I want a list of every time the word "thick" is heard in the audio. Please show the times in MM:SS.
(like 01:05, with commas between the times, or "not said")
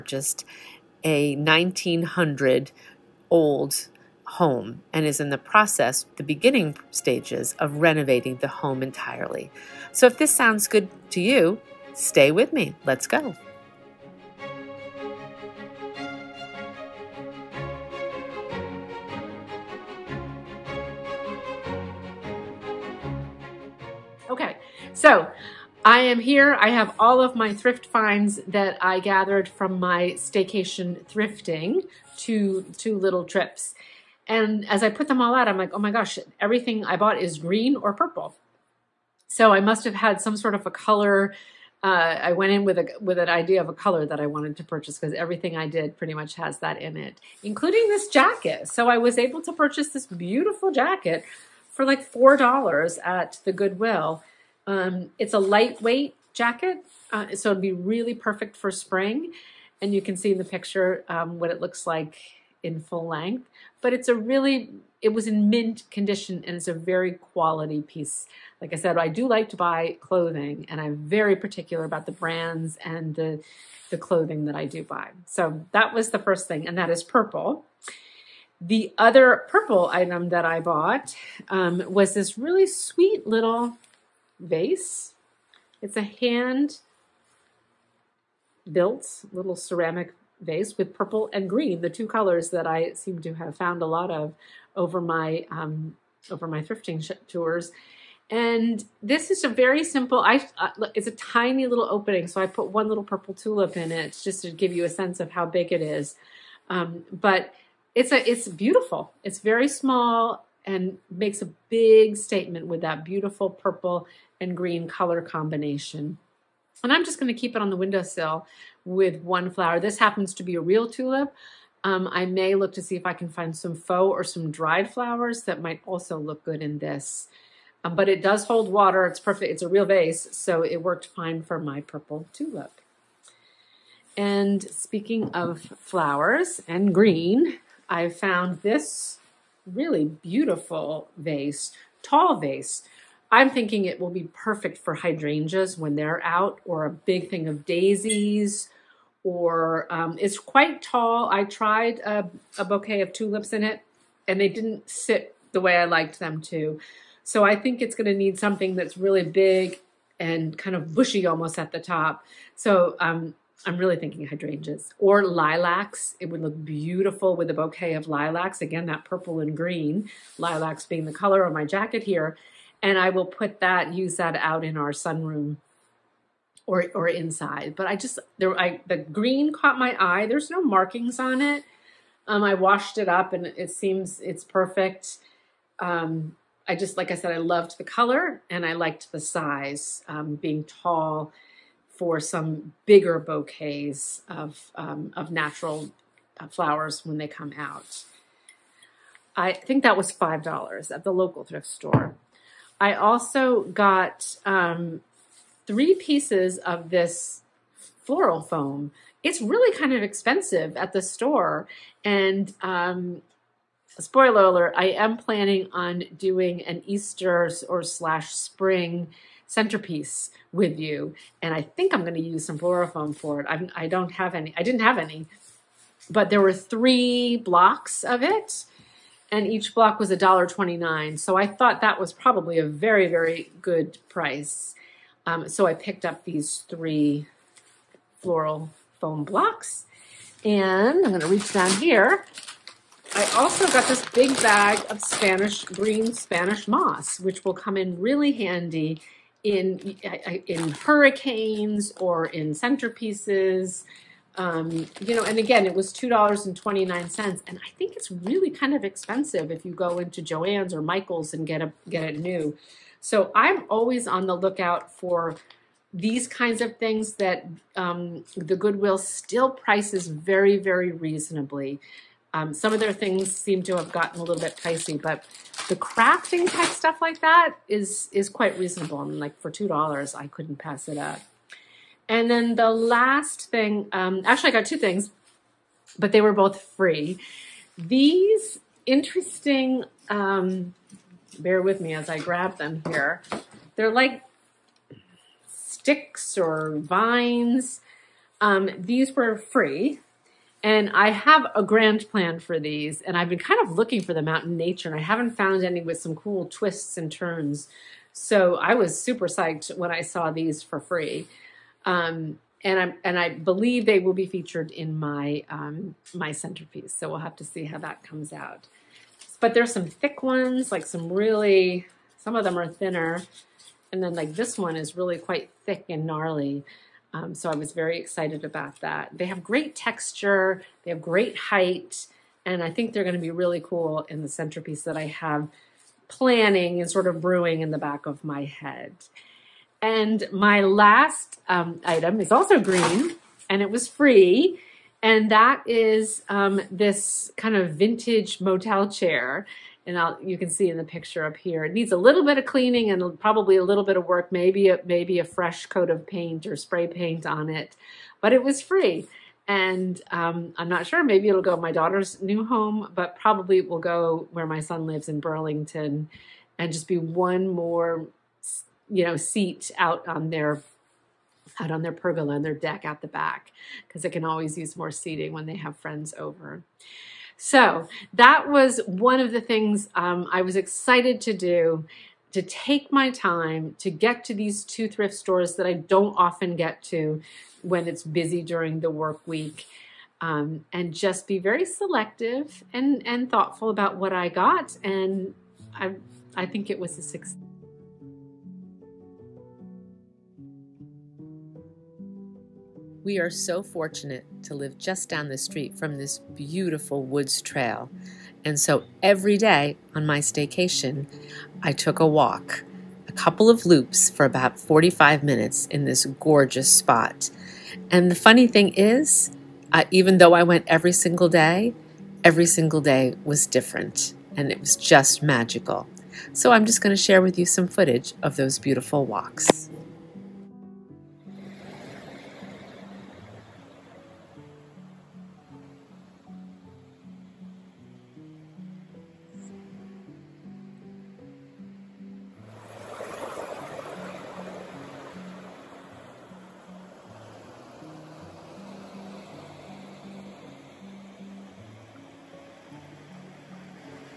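05:19, 05:25.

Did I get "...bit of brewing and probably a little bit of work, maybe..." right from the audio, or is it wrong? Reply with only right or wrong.
wrong.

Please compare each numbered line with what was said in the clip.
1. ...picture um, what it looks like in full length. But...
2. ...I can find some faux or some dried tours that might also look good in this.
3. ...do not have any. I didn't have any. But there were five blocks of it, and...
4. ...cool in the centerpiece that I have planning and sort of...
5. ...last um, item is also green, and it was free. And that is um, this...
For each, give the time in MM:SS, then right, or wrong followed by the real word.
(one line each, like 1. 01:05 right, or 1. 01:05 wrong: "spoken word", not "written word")
1. 01:00 right
2. 02:03 wrong: "flowers", not "tours"
3. 03:43 wrong: "three", not "five"
4. 05:33 right
5. 05:40 right.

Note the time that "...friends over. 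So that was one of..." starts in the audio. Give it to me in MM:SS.
06:15.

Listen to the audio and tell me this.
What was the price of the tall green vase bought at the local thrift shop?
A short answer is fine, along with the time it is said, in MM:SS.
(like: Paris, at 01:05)
$5, at 03:20.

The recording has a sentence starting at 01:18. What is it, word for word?
The other purple item that I bought um, was this really sweet little vase.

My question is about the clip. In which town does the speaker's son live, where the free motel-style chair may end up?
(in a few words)
Burlington.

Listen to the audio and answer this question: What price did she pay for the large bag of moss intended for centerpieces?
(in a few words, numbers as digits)
$2.29.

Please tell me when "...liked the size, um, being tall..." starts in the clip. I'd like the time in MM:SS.
03:08.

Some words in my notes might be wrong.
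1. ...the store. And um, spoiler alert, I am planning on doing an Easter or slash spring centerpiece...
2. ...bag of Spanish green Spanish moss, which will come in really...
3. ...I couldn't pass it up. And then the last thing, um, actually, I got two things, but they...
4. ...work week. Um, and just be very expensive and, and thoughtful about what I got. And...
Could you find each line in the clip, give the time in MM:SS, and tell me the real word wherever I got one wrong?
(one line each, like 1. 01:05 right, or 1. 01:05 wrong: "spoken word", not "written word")
1. 03:30 right
2. 04:04 right
3. 04:40 right
4. 06:28 wrong: "selective", not "expensive".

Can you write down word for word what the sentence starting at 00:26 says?
I have all of my thrift finds that I gathered from my staycation thrifting, two, two little trips.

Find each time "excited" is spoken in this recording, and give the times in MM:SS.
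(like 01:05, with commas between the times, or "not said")
05:27, 06:20.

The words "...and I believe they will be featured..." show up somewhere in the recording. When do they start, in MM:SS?
05:13.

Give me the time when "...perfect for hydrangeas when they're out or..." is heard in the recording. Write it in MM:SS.
02:24.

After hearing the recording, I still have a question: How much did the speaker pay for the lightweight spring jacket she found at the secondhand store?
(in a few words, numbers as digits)
$4.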